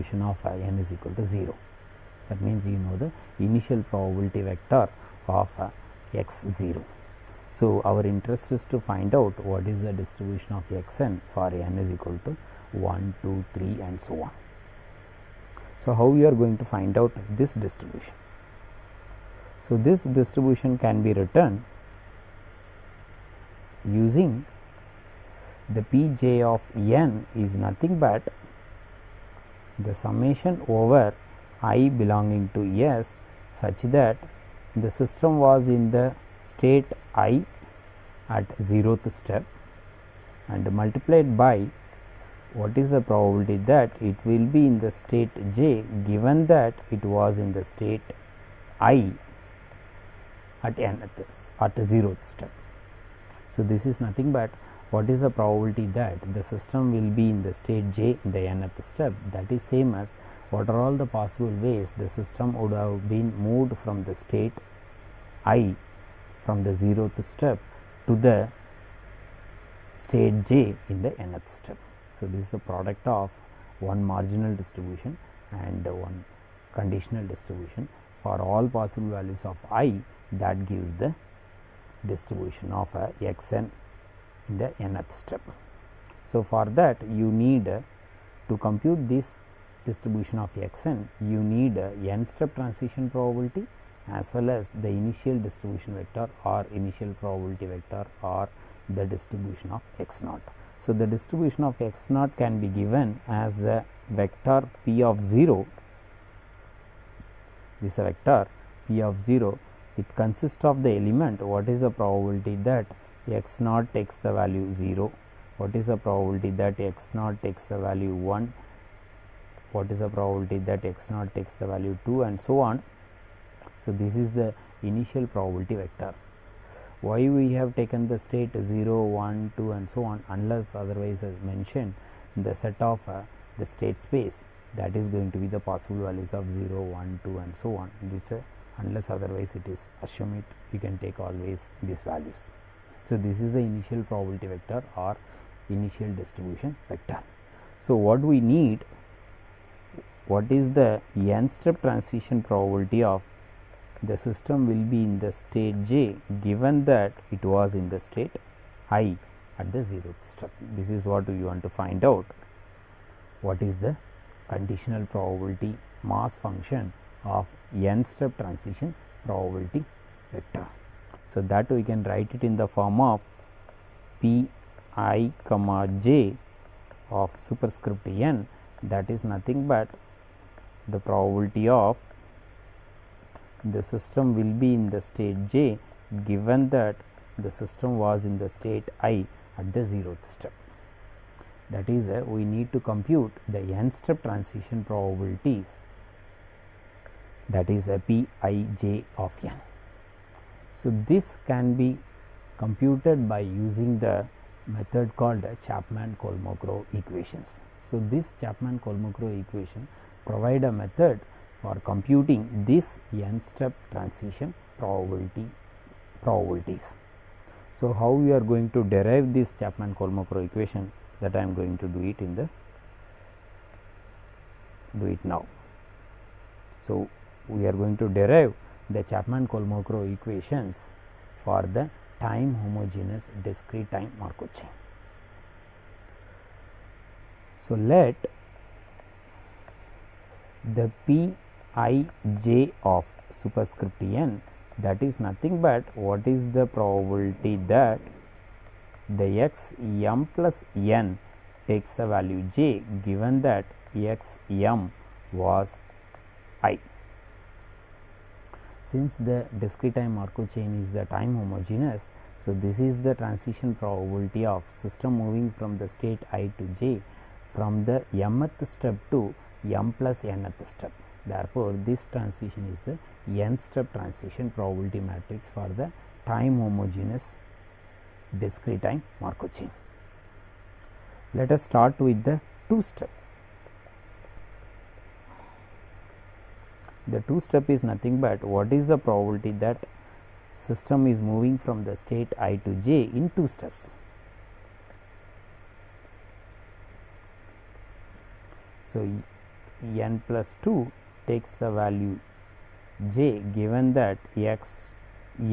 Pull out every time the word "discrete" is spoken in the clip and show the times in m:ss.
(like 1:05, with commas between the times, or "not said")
3:53, 4:19, 4:38.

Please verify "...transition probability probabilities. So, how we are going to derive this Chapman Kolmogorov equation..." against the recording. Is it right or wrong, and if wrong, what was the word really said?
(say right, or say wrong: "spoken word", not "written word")
right.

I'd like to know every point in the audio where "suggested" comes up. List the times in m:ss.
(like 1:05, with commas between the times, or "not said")
not said.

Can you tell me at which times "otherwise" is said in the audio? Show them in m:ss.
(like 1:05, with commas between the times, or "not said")
2:10, 2:19.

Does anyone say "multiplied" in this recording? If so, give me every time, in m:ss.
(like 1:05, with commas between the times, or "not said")
0:40.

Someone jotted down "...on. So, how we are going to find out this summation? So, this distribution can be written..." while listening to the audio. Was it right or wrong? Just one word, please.
wrong.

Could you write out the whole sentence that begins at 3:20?
So, this can be computed by using the method called Chapman Kolmogorov equations.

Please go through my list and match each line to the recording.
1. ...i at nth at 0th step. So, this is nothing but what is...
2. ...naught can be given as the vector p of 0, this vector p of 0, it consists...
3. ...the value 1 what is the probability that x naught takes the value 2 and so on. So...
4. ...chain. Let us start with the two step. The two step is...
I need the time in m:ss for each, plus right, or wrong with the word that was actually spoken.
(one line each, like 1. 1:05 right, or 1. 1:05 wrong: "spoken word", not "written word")
1. 0:48 right
2. 1:42 right
3. 1:57 right
4. 4:39 right.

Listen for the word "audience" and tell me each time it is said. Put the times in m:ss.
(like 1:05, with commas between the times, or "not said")
not said.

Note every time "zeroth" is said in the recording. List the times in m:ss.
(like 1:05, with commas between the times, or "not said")
1:06, 2:39, 3:09.